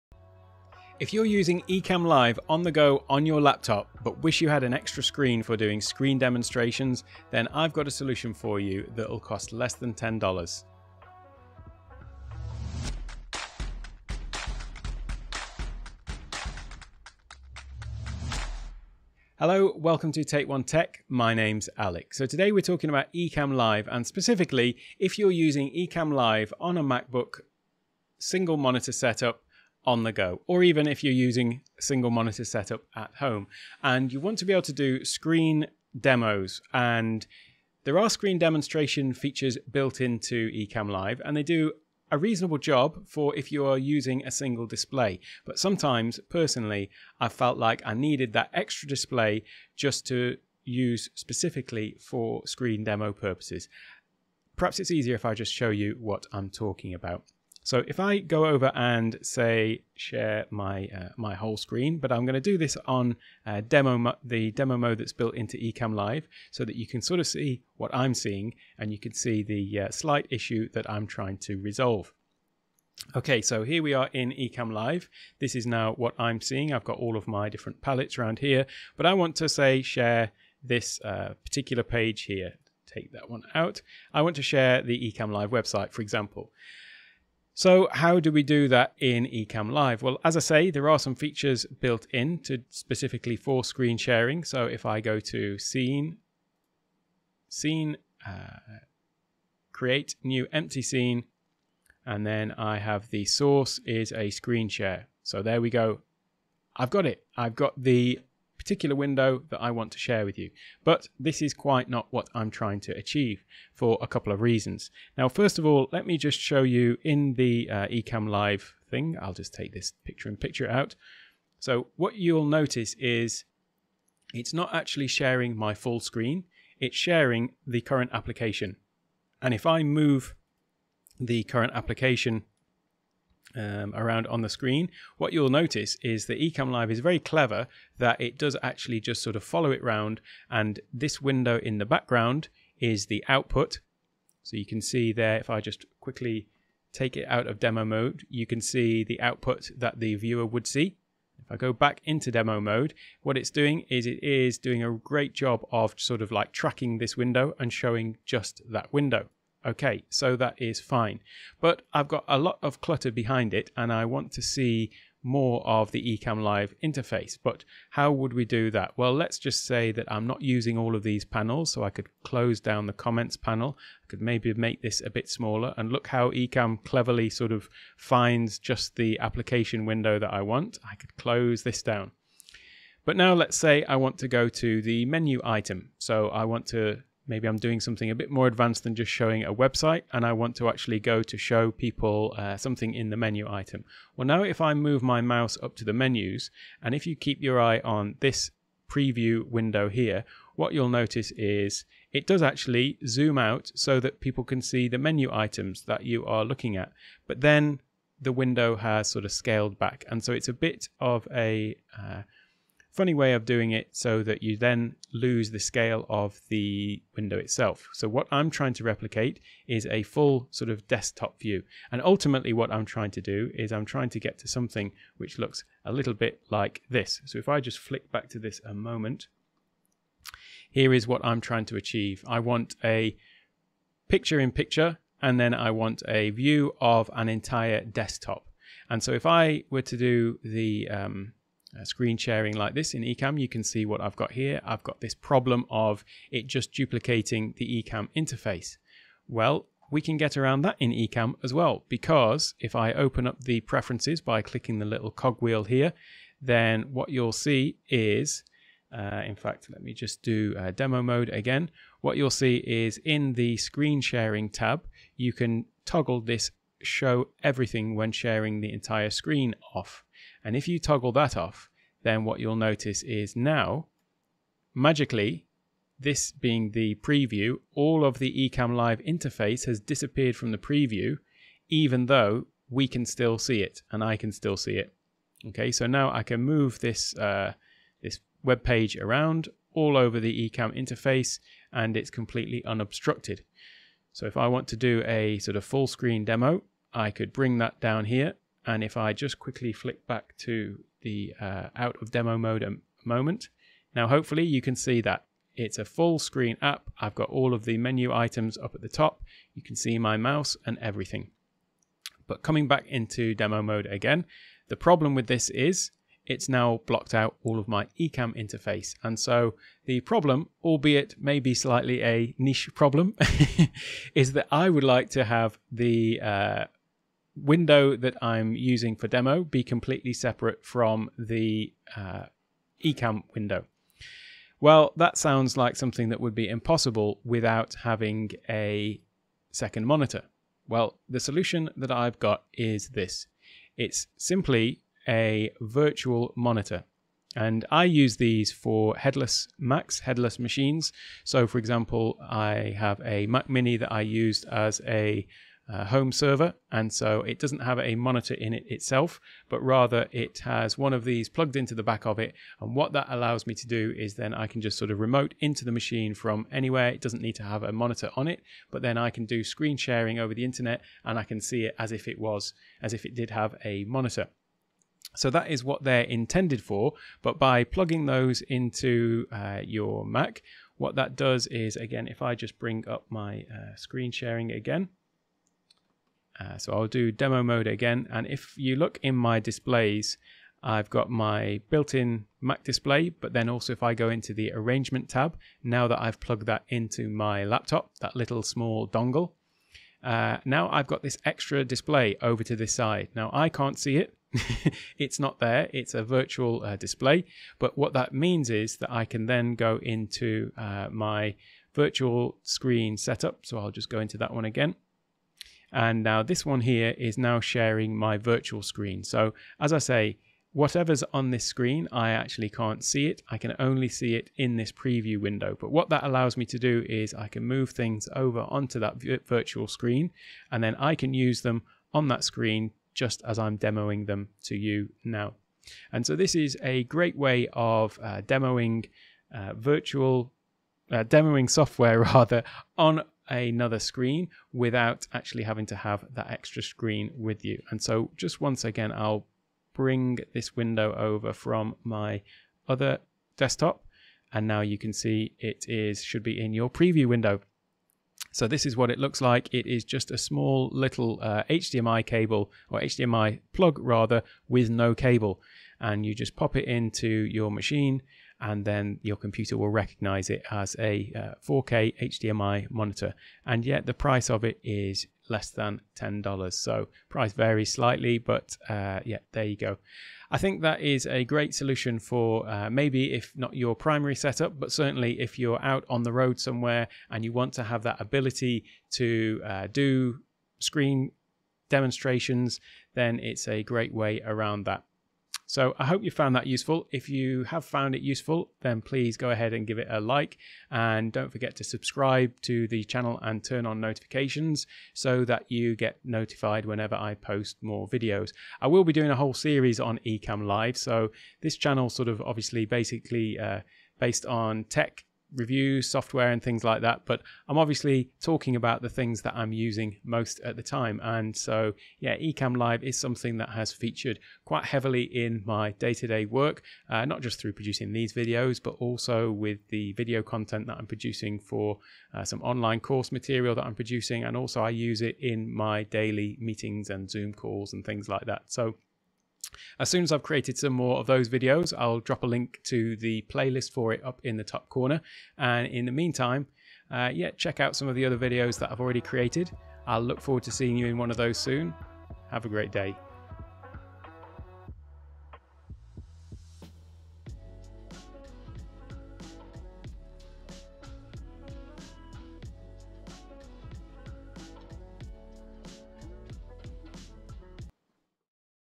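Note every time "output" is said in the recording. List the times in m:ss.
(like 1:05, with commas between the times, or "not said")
2:23, 2:29.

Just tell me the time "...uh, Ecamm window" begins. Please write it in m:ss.
5:31.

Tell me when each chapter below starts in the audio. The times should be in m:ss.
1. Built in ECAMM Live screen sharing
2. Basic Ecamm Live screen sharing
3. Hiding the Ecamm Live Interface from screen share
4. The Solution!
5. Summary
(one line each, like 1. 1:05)
1. 0:55
2. 1:20
3. 4:10
4. 5:40
5. 8:00.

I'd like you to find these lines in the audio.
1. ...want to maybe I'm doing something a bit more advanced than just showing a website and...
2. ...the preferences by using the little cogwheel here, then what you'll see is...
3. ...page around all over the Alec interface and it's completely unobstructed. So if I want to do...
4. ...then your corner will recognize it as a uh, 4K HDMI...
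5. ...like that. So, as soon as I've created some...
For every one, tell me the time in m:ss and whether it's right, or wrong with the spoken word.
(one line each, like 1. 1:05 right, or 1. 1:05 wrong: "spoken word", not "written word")
1. 3:06 right
2. 4:13 wrong: "clicking", not "using"
3. 4:48 wrong: "Ecamm", not "Alec"
4. 7:48 wrong: "computer", not "corner"
5. 8:58 right.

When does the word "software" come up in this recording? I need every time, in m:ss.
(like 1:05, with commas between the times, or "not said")
7:21, 8:35.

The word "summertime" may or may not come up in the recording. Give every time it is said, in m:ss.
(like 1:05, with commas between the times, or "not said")
not said.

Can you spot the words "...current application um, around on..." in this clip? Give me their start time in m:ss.
2:11.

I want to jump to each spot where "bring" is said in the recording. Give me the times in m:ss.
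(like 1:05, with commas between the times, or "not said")
4:57, 6:22, 7:29.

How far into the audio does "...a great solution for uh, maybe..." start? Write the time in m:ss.
8:01.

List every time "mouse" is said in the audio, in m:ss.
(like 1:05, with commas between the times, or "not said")
3:15, 5:10.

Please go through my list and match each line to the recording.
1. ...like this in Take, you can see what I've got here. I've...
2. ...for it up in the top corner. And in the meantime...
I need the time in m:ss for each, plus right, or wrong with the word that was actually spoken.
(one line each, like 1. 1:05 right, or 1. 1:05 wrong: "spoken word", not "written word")
1. 4:02 wrong: "Ecamm", not "Take"
2. 9:03 right.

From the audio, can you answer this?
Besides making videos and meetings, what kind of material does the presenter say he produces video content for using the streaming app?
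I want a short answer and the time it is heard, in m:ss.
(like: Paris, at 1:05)
Online course material, at 8:52.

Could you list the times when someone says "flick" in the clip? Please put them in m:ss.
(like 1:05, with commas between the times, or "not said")
3:47, 4:59.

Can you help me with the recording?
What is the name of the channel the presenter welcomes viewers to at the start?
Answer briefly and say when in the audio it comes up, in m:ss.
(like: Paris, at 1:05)
Take One Tech, at 0:20.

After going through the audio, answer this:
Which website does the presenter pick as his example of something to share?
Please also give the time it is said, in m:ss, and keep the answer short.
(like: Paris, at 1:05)
The Ecamm Live website, at 1:24.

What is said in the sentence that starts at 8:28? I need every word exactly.
I will be doing a whole series on Ecamm Live.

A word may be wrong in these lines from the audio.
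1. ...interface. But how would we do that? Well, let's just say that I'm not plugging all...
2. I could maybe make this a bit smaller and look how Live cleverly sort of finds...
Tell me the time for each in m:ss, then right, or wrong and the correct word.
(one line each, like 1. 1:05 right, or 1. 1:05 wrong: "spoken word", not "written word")
1. 2:46 wrong: "using", not "plugging"
2. 2:54 wrong: "Ecamm", not "Live".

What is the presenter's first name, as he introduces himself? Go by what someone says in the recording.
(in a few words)
Alec.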